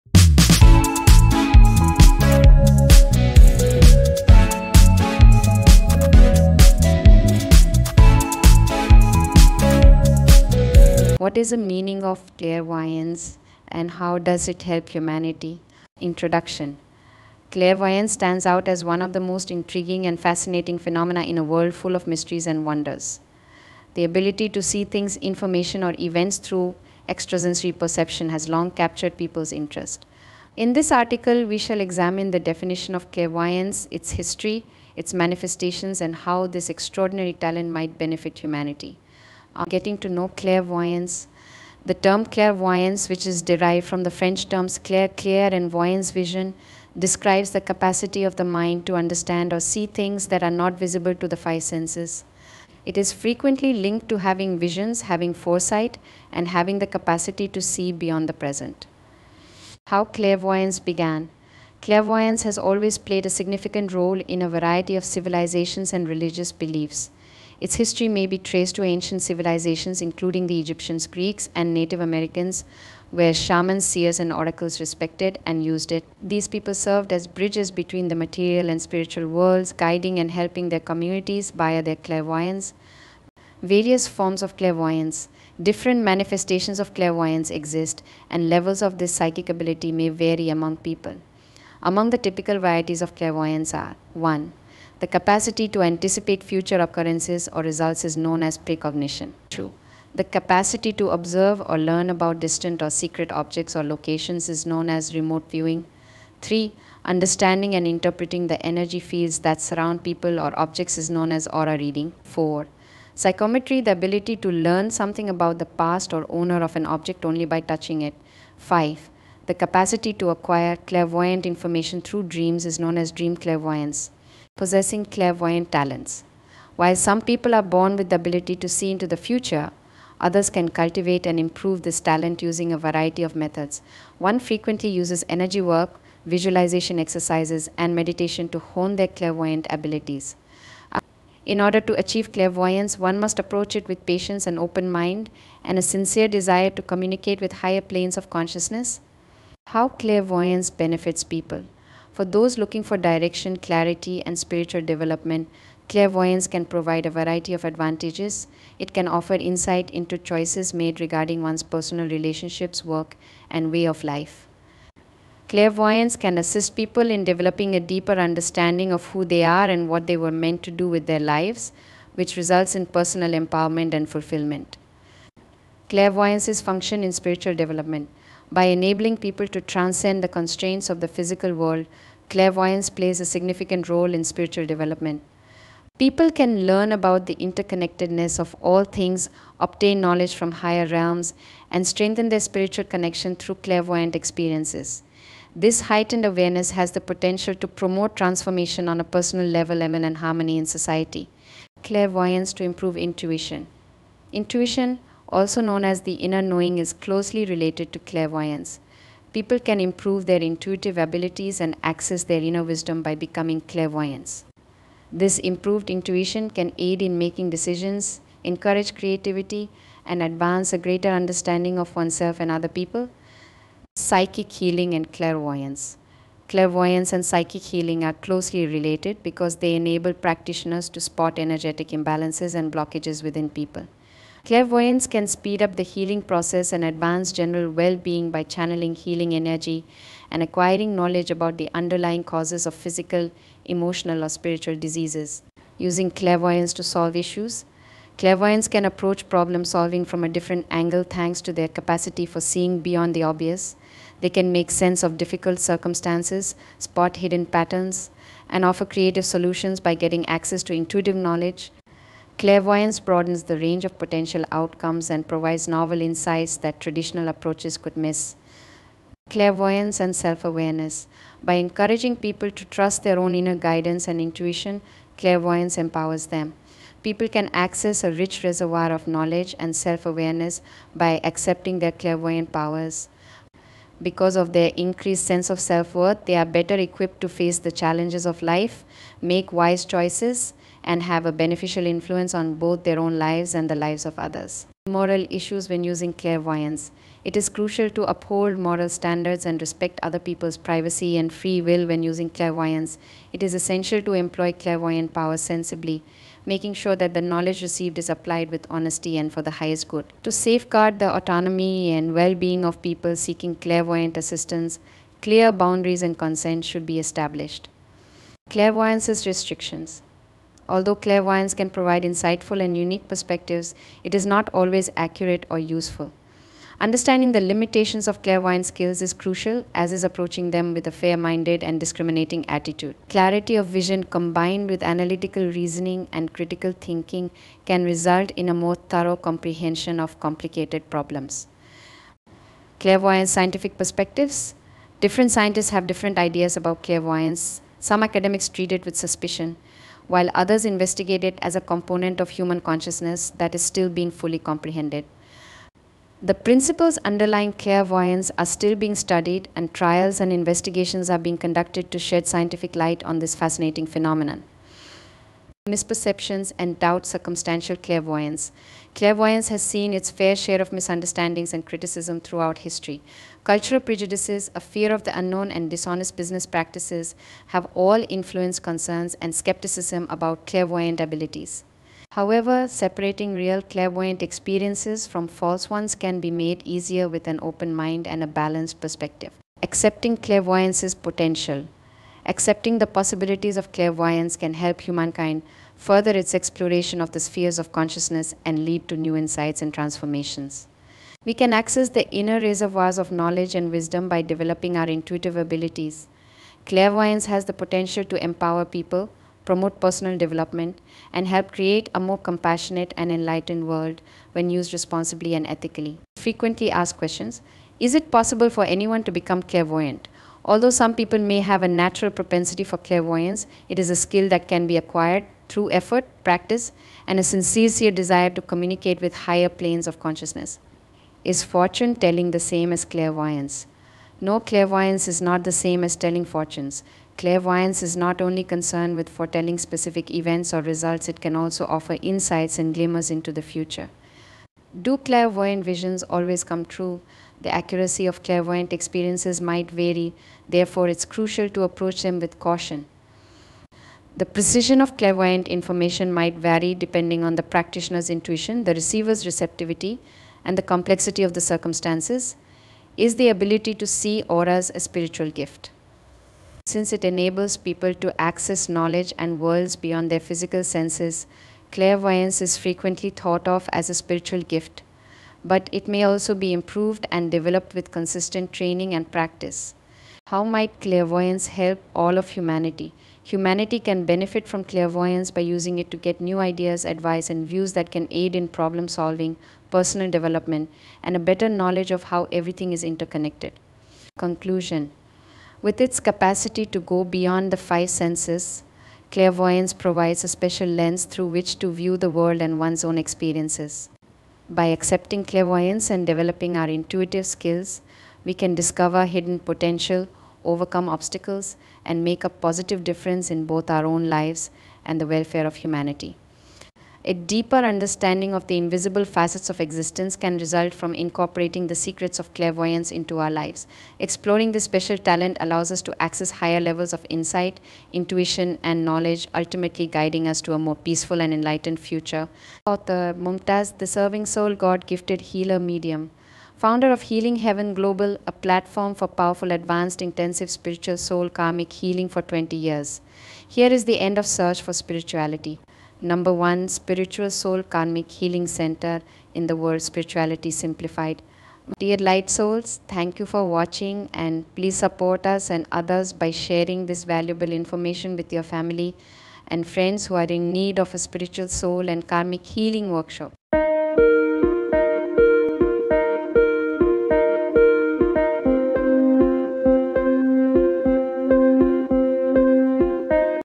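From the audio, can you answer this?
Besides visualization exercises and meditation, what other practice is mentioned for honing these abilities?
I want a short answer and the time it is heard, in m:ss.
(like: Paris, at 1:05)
Energy work, at 2:15.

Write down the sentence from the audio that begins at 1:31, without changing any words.
Among the typical varieties of clairvoyance are 1.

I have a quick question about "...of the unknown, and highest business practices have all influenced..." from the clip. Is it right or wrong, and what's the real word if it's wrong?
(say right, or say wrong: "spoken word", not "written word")
wrong: "dishonest", not "highest".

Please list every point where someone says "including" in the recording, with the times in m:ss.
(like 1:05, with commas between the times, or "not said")
1:10.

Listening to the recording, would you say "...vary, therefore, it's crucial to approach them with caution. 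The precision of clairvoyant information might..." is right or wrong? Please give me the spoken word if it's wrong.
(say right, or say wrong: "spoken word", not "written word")
right.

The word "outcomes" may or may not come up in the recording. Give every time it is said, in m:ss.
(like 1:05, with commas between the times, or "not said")
4:24.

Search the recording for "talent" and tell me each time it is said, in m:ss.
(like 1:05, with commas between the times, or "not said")
0:37, 2:05, 2:11, 8:44.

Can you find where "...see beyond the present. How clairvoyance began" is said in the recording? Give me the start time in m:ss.
0:57.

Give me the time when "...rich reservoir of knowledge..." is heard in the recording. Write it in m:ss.
4:38.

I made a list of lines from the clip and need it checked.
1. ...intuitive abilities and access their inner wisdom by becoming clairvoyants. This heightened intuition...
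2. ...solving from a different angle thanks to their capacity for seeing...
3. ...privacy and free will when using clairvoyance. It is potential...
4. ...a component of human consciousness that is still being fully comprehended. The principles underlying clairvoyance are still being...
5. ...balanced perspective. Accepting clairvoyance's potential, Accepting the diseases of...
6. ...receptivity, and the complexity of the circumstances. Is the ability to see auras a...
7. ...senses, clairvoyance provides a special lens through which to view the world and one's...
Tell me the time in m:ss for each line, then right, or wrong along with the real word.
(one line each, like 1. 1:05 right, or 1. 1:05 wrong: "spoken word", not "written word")
1. 3:30 wrong: "improved", not "heightened"
2. 4:09 right
3. 5:00 wrong: "essential", not "potential"
4. 5:51 right
5. 6:28 wrong: "possibilities", not "diseases"
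6. 7:39 right
7. 8:17 right.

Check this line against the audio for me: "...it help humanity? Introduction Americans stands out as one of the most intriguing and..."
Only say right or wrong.
wrong.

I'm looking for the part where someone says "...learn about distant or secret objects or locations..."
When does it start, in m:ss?
1:41.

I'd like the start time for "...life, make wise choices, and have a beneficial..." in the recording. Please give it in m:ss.
4:48.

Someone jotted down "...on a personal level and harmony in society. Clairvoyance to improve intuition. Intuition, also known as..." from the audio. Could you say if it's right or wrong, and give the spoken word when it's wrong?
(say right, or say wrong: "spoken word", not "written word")
right.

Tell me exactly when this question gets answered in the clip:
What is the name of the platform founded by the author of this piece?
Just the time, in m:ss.
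8:57.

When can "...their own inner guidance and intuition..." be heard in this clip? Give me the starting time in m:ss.
4:33.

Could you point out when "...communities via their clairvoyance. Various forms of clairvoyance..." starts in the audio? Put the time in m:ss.
1:20.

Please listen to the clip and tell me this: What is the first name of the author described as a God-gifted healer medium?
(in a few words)
Mumtaz.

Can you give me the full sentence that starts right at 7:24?
Do clairvoyant visions always come true?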